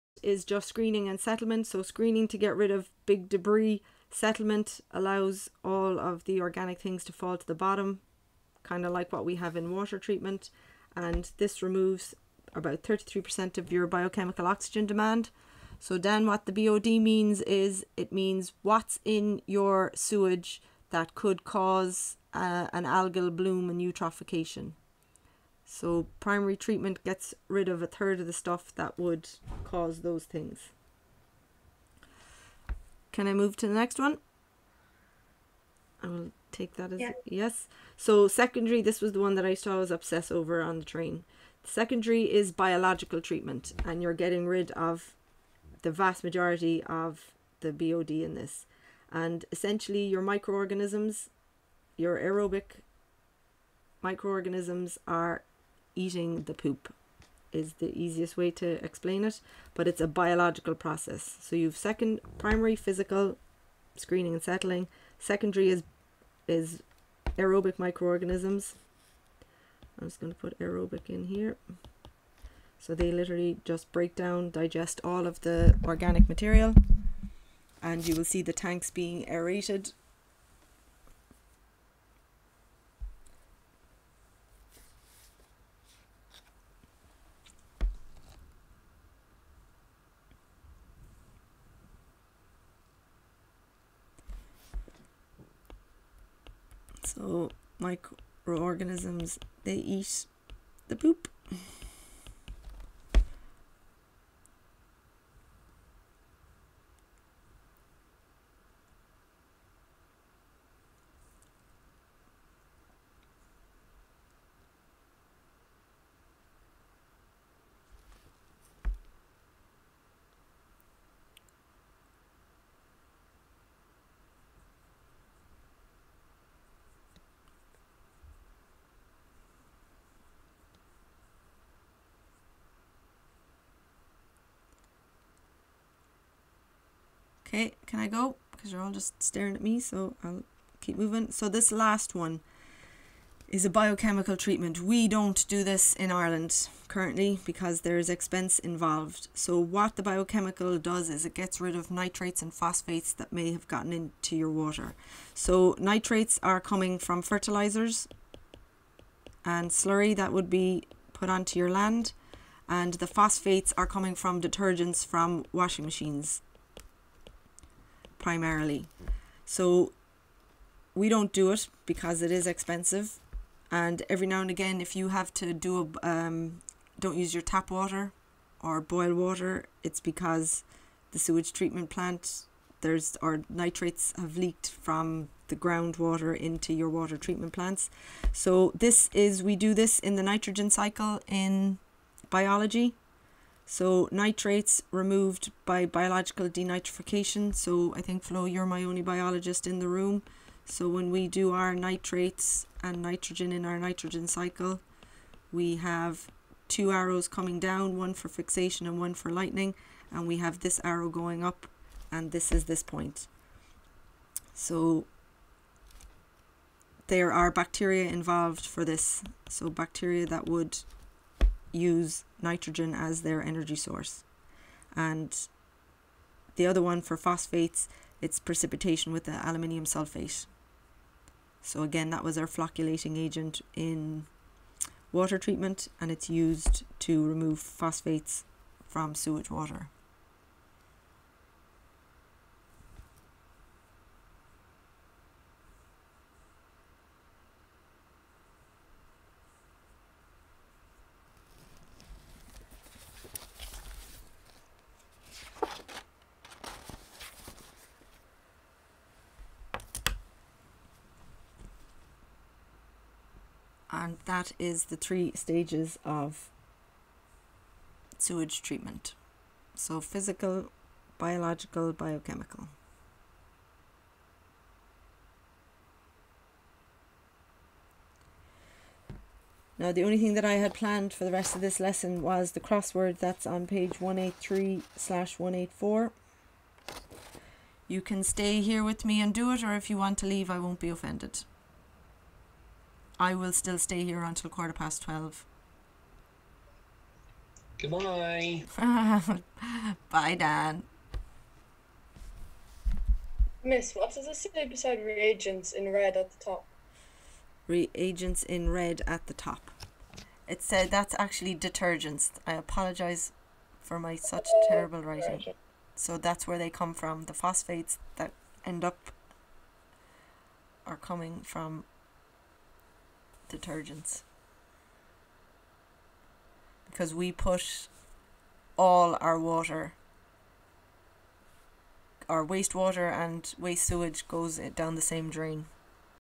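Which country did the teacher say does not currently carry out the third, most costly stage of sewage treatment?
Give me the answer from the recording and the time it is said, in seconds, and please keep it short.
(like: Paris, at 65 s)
Ireland, at 146 s.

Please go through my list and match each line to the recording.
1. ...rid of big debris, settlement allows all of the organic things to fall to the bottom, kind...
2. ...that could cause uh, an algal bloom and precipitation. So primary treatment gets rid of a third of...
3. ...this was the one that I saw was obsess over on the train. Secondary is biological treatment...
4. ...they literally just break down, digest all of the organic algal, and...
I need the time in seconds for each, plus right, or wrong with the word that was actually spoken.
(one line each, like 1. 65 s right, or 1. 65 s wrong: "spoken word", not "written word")
1. 2 s right
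2. 20 s wrong: "eutrophication", not "precipitation"
3. 38 s right
4. 72 s wrong: "material", not "algal".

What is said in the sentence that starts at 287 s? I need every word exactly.
You can stay here with me and do it or if you want to leave I won't be offended.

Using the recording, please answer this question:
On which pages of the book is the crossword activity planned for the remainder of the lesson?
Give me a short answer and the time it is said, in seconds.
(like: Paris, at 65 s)
183/184, at 283 s.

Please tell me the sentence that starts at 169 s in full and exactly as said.
So we don't do it because it is expensive.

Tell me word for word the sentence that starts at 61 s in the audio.
So you've second primary physical screening and settling, secondary is is aerobic microorganisms.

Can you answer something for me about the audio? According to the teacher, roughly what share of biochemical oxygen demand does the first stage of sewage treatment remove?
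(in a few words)
33%.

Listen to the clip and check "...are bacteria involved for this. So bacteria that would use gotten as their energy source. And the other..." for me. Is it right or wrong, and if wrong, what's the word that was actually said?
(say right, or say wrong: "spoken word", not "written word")
wrong: "nitrogen", not "gotten".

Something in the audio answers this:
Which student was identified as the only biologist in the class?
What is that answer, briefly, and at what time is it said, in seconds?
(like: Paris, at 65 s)
Flo, at 198 s.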